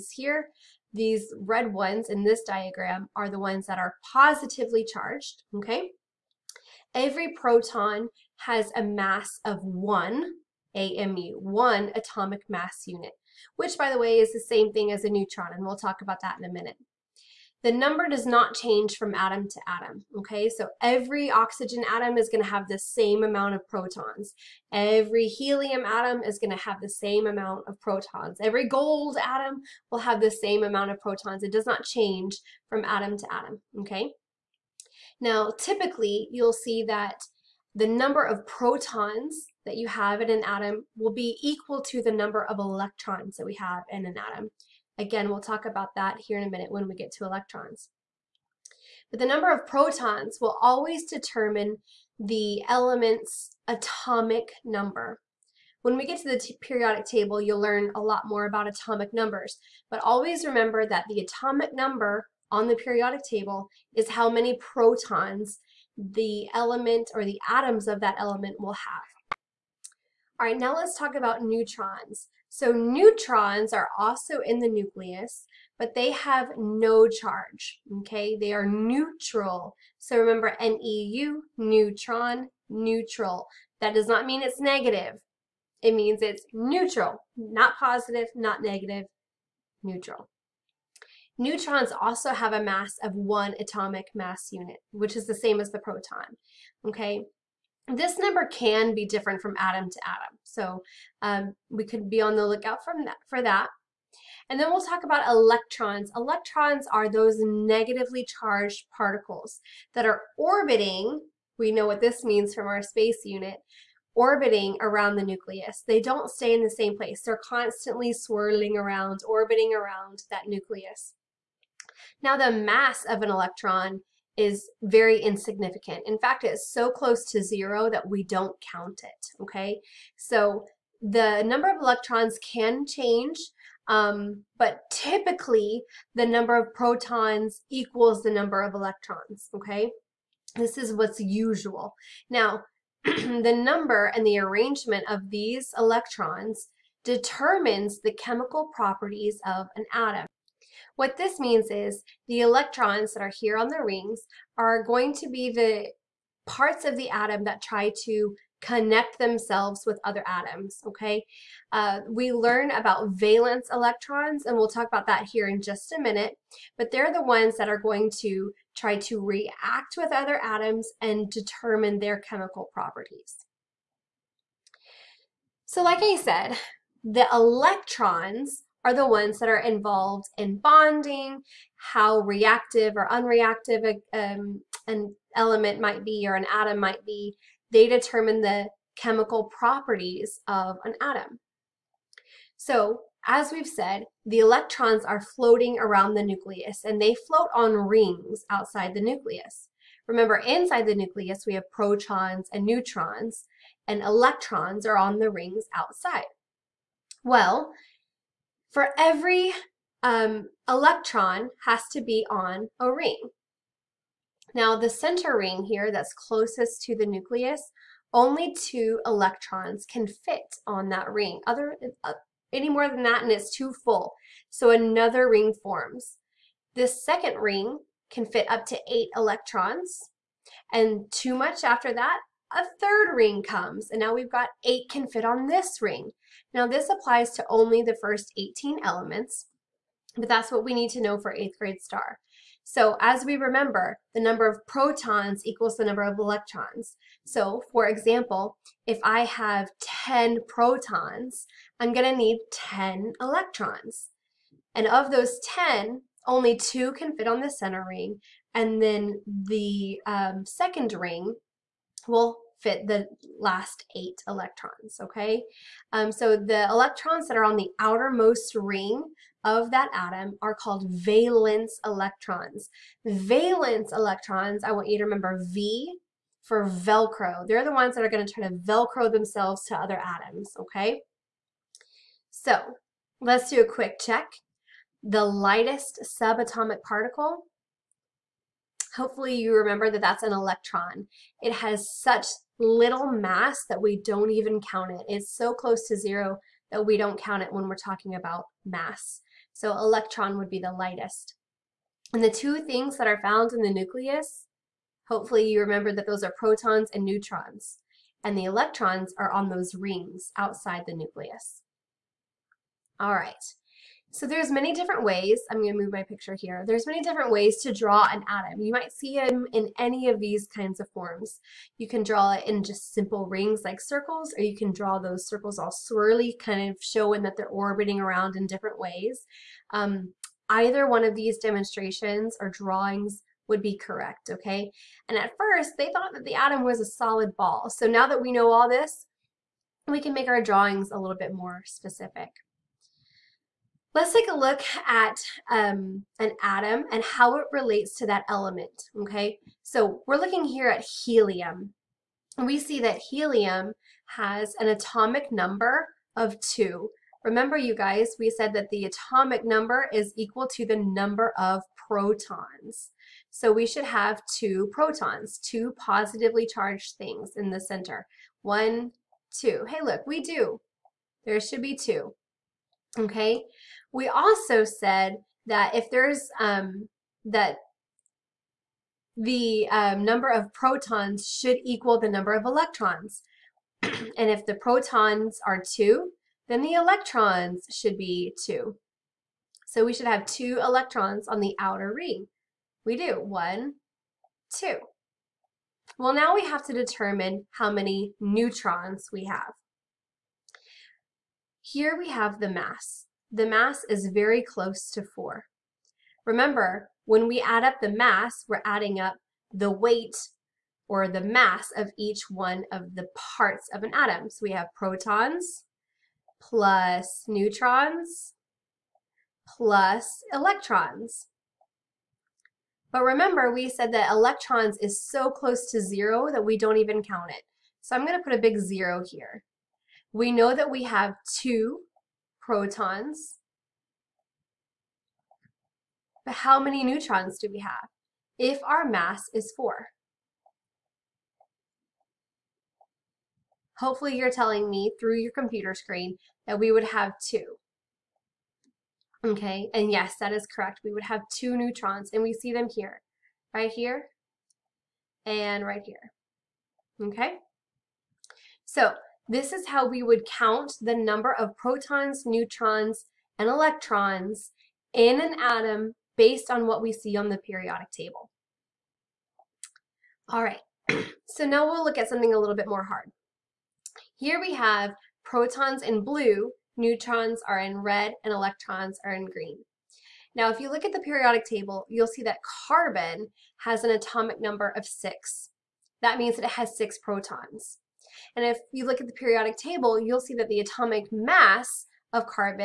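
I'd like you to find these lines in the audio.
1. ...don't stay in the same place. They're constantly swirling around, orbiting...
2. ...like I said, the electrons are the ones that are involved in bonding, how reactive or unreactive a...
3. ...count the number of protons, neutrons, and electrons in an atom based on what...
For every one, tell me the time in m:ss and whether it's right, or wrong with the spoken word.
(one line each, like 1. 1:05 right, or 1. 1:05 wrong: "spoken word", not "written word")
1. 1:56 right
2. 2:55 right
3. 7:40 right.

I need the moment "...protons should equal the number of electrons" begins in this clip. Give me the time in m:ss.
6:20.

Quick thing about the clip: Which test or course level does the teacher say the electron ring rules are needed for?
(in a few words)
eighth grade STAR.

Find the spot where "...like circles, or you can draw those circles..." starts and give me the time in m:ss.
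5:23.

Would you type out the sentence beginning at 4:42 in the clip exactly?
So let's do a quick check.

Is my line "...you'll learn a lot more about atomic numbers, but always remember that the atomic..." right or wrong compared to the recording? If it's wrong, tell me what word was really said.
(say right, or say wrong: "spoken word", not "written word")
right.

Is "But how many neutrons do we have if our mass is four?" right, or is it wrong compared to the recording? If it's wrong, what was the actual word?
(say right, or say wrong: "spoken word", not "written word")
right.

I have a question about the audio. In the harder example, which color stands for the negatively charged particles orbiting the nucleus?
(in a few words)
green.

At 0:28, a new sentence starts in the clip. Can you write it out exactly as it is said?
Every gold atom will have the same amount of protons.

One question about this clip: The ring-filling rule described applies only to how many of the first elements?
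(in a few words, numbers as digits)
18.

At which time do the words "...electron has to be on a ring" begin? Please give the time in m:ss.
3:30.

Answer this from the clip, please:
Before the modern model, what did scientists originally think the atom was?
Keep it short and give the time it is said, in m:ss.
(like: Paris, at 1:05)
a solid ball, at 5:36.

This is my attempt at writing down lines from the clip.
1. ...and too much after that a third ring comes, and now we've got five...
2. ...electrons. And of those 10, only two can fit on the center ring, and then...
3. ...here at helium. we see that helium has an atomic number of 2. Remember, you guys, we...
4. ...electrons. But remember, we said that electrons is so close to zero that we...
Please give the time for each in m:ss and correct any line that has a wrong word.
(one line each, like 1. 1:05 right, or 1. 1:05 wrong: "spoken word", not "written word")
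1. 3:50 wrong: "eight", not "five"
2. 4:13 right
3. 5:50 right
4. 7:00 right.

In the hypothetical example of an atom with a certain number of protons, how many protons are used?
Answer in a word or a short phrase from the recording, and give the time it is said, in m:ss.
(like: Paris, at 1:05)
10, at 4:10.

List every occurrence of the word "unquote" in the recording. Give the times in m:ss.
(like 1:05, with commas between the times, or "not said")
not said.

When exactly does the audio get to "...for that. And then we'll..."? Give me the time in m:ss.
1:43.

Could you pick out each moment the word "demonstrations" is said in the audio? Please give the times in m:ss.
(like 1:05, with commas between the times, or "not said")
5:31.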